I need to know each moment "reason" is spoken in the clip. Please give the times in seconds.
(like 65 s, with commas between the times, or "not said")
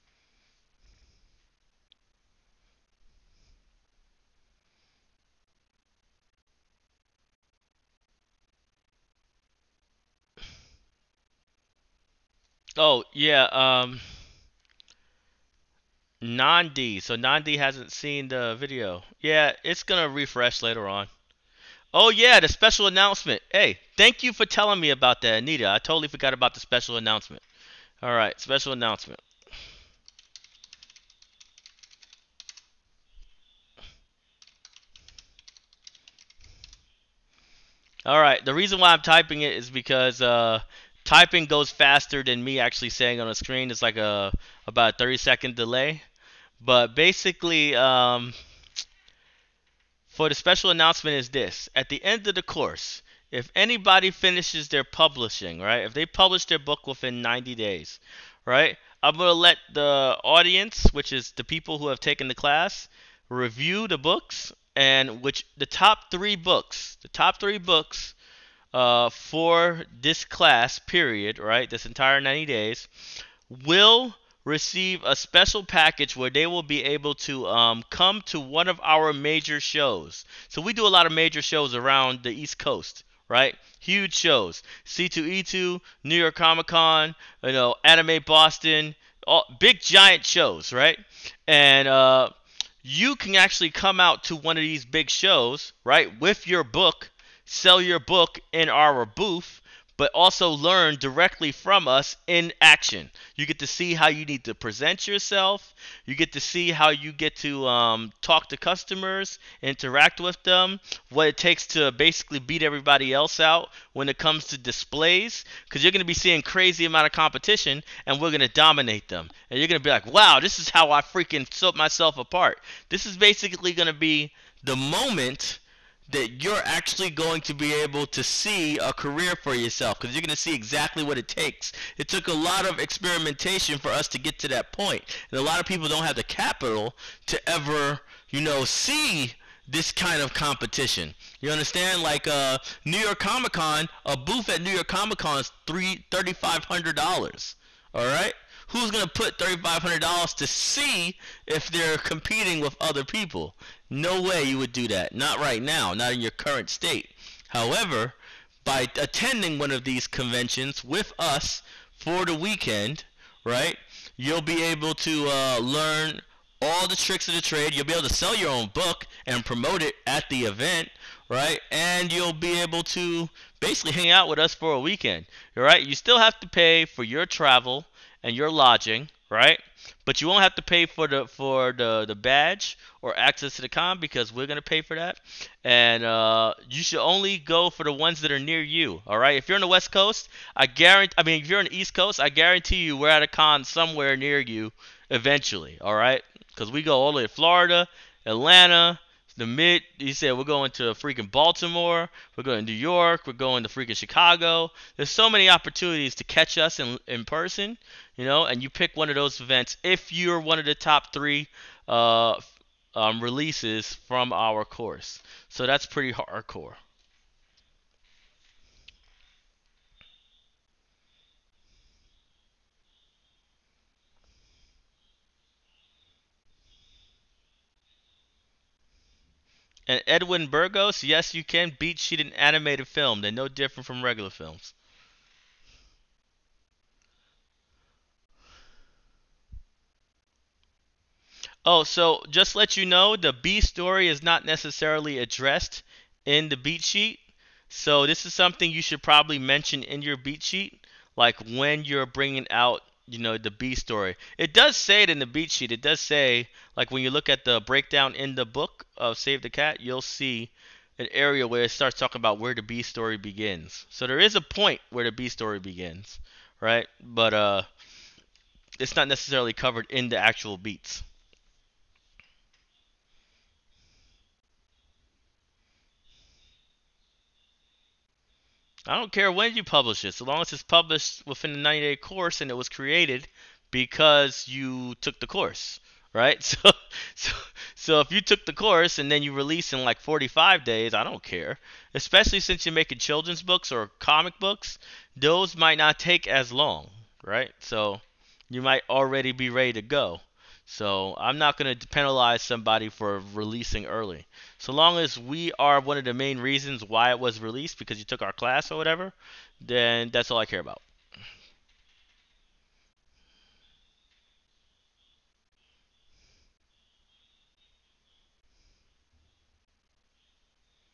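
38 s, 306 s.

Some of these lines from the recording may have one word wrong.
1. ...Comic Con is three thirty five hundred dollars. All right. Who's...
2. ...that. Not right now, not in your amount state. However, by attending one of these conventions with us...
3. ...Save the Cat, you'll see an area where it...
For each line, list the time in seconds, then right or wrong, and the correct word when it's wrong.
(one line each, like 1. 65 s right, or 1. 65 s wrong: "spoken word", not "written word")
1. 144 s right
2. 154 s wrong: "current", not "amount"
3. 259 s right.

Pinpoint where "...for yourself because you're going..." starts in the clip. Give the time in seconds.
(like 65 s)
129 s.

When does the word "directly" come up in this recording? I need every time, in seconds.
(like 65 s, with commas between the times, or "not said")
100 s.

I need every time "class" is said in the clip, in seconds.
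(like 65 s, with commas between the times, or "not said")
62 s, 70 s, 308 s.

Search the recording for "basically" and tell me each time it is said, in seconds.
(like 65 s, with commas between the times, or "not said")
46 s, 111 s, 123 s, 173 s.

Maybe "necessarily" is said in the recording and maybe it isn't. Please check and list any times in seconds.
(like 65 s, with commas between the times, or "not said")
244 s, 269 s.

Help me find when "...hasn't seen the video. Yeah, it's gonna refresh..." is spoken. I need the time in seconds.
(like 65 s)
17 s.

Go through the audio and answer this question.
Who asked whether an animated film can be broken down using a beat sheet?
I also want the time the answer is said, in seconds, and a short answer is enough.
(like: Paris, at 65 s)
Edwin Burgos, at 230 s.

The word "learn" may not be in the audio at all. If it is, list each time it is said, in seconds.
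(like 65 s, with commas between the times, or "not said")
100 s, 165 s.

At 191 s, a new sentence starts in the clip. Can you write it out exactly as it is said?
I mean, if you're on the East Coast, I guarantee you we're at a con somewhere near you eventually.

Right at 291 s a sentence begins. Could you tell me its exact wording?
Especially since you're making children's books or comic books, those might not take as long, right?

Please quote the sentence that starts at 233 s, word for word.
They're no different from regular films.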